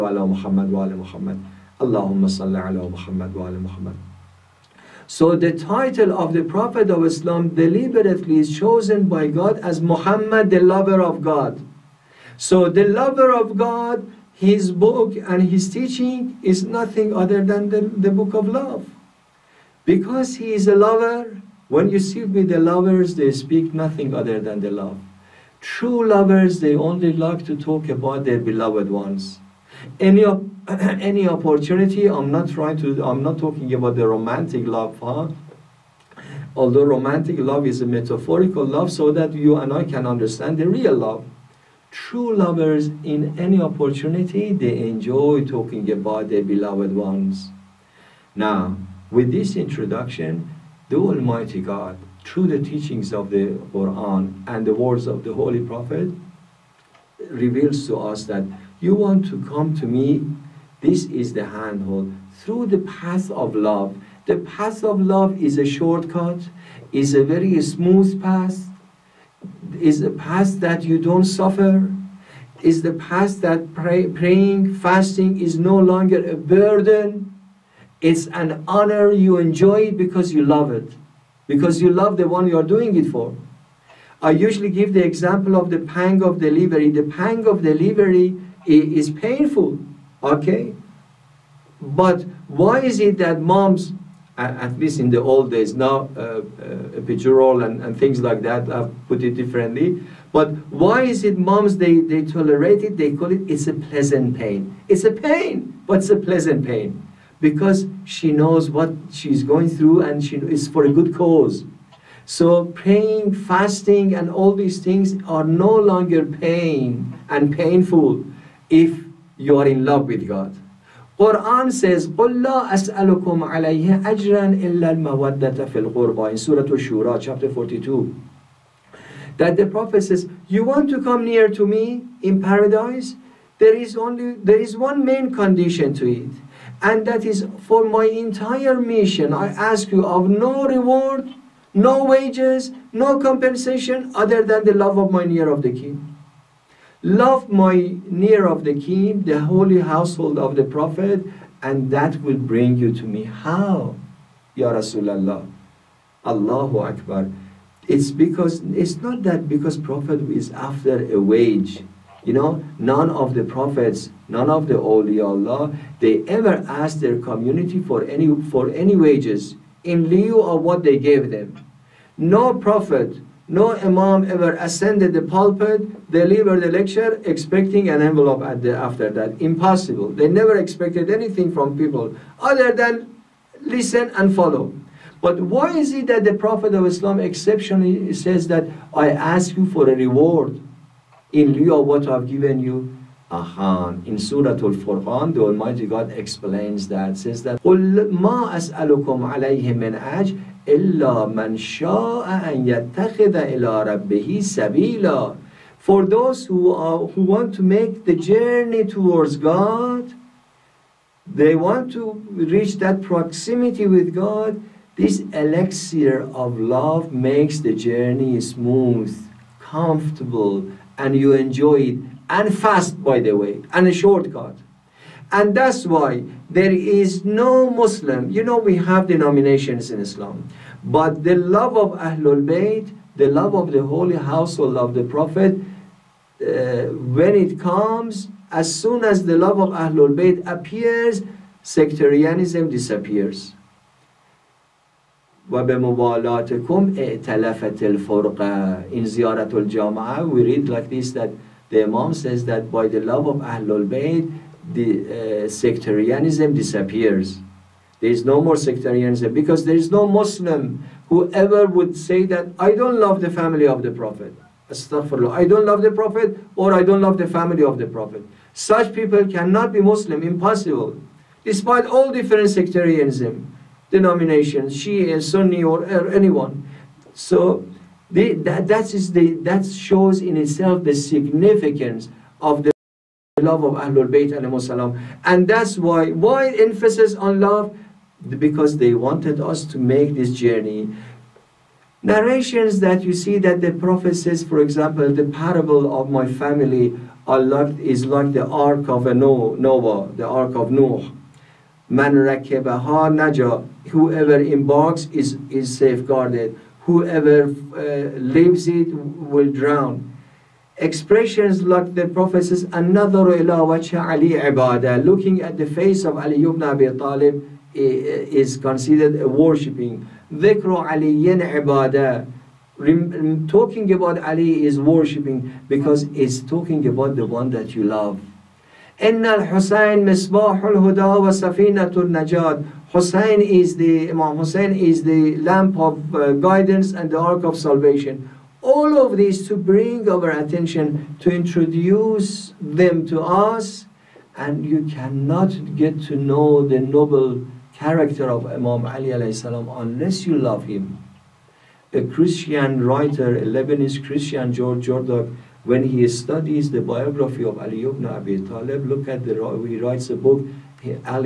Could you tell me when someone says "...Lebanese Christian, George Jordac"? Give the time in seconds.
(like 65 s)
353 s.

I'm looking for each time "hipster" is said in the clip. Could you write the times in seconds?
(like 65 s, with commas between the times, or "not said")
not said.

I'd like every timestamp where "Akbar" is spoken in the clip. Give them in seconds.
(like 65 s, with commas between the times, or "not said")
156 s.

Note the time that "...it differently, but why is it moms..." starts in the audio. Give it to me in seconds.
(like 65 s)
99 s.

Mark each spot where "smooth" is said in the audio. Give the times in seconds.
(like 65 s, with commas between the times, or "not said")
67 s, 218 s.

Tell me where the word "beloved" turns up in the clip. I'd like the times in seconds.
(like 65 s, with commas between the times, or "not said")
28 s, 46 s.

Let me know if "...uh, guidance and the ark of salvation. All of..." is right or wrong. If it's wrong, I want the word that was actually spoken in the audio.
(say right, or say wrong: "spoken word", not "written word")
right.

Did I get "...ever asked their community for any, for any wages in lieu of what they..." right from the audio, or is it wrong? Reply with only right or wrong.
right.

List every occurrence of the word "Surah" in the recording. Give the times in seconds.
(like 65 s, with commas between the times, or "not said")
126 s, 194 s.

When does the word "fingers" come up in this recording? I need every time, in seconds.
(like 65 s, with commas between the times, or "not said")
not said.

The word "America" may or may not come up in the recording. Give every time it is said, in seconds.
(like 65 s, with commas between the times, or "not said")
not said.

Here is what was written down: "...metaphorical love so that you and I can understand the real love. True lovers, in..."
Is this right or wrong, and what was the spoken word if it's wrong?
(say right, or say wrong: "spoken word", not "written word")
right.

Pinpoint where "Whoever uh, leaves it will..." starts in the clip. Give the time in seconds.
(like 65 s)
306 s.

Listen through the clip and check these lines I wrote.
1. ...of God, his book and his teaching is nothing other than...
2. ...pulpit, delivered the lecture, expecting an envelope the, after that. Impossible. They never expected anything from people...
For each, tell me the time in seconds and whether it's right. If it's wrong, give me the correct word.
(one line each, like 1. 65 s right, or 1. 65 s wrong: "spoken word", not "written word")
1. 13 s right
2. 175 s right.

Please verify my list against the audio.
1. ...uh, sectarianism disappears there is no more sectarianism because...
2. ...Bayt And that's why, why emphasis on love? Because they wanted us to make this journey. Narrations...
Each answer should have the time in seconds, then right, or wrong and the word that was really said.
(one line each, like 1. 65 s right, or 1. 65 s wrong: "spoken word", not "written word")
1. 255 s right
2. 284 s right.